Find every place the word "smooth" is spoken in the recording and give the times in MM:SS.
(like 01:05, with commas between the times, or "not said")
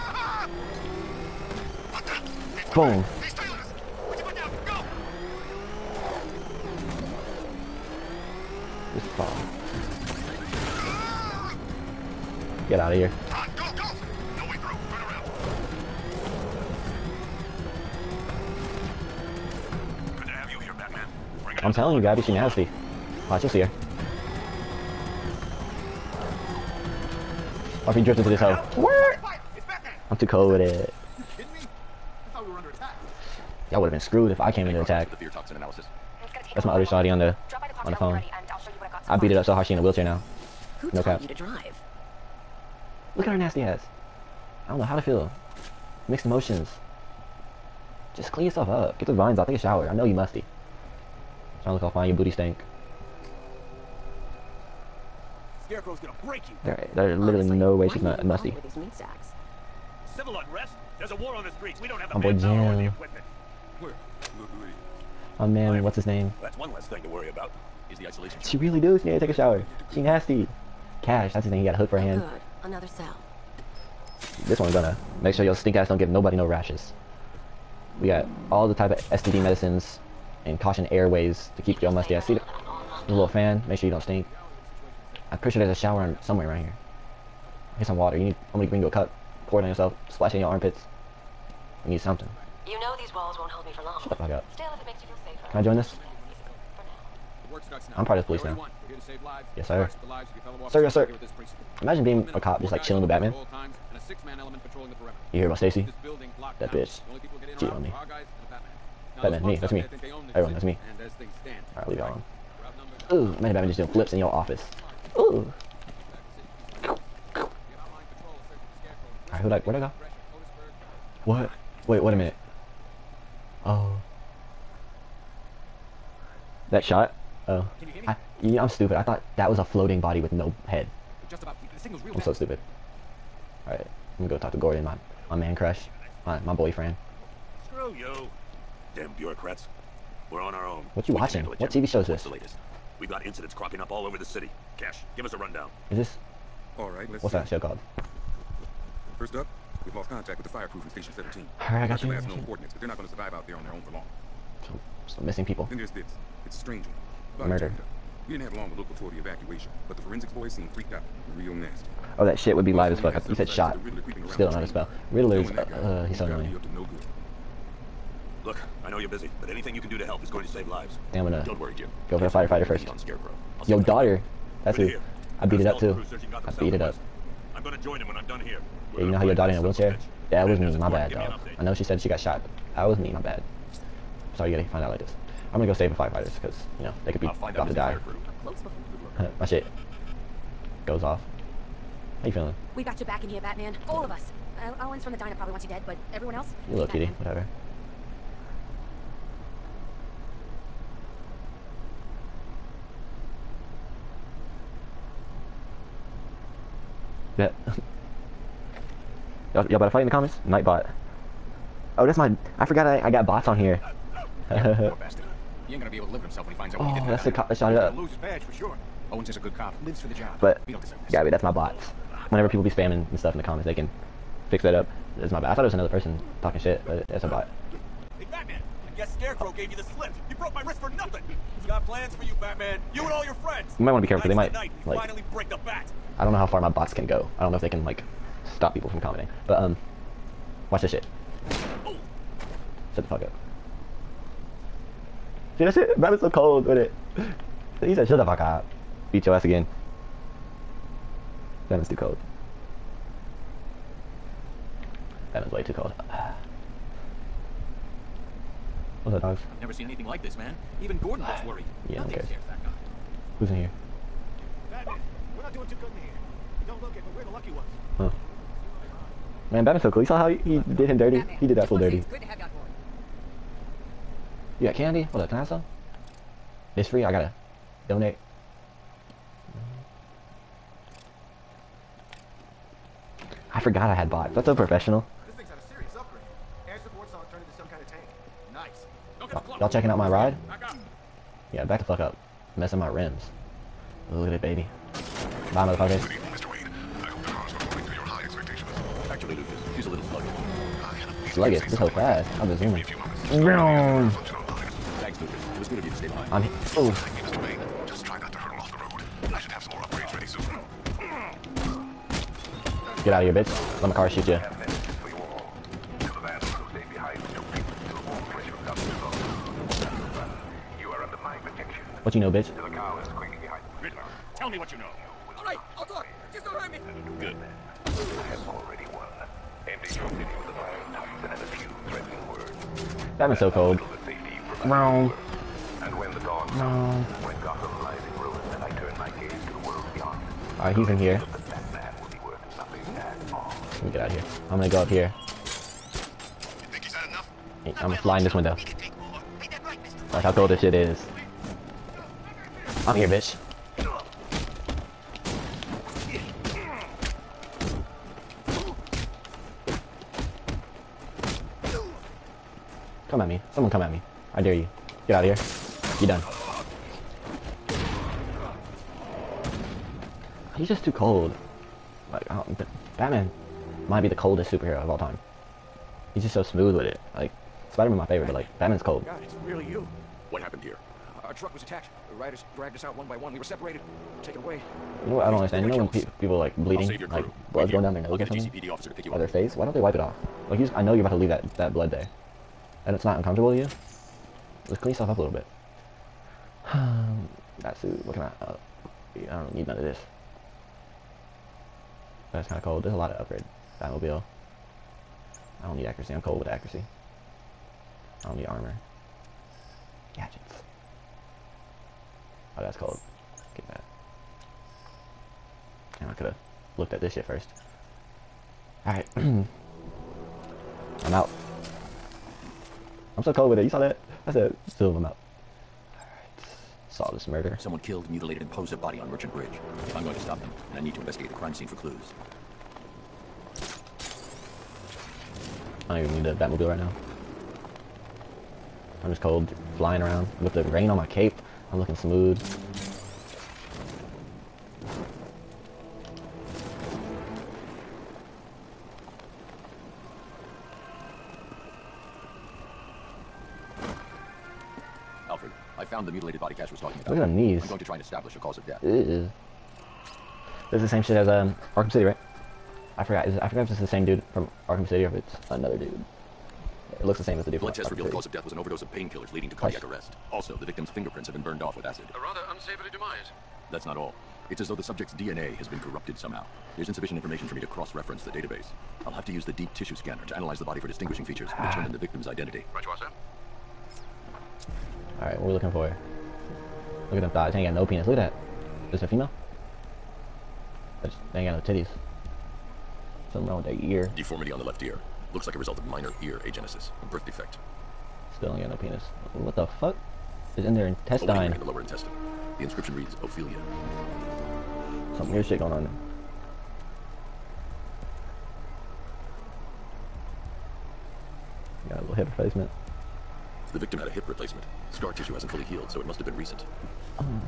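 06:16, 07:21.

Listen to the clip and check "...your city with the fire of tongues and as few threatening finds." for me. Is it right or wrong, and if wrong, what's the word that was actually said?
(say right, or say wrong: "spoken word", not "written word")
wrong: "words", not "finds".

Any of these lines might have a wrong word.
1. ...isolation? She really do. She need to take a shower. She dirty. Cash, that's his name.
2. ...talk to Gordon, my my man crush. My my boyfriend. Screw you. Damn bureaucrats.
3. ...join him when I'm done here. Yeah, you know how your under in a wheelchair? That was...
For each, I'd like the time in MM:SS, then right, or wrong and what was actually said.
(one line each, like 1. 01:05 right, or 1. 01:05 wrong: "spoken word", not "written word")
1. 01:08 wrong: "nasty", not "dirty"
2. 02:14 right
3. 02:57 wrong: "daughter", not "under".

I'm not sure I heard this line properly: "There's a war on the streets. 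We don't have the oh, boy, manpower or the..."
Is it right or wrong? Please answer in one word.
right.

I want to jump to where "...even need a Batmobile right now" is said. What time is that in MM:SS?
07:16.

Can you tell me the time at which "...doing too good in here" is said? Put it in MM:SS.
04:25.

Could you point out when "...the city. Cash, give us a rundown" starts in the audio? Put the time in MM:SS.
02:24.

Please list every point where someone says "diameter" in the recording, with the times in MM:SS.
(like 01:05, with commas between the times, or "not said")
not said.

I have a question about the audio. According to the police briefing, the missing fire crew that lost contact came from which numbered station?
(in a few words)
Station 17.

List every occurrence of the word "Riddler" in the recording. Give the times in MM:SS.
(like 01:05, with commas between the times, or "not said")
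02:45, 05:23.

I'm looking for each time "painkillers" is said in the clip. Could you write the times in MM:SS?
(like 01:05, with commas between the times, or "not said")
07:48.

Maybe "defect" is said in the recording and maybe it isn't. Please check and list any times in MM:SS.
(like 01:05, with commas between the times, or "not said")
08:17.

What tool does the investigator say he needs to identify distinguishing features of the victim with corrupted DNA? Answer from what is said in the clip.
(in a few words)
Deep tissue scanner.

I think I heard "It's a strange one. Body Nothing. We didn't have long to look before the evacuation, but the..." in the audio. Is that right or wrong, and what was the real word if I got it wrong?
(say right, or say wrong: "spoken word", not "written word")
wrong: "Murder", not "Nothing".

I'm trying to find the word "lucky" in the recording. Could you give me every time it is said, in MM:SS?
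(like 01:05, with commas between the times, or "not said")
04:27.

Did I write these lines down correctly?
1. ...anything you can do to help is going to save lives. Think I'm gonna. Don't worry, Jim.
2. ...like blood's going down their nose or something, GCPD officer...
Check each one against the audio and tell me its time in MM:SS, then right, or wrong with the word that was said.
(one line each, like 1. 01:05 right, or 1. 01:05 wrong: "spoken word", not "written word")
1. 02:49 right
2. 06:27 right.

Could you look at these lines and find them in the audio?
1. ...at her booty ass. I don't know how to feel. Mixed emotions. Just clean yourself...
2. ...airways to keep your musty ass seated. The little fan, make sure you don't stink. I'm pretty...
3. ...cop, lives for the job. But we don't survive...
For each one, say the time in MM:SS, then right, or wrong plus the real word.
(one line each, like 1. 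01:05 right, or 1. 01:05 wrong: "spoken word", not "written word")
1. 00:43 wrong: "nasty", not "booty"
2. 01:20 right
3. 03:39 wrong: "deserve", not "survive".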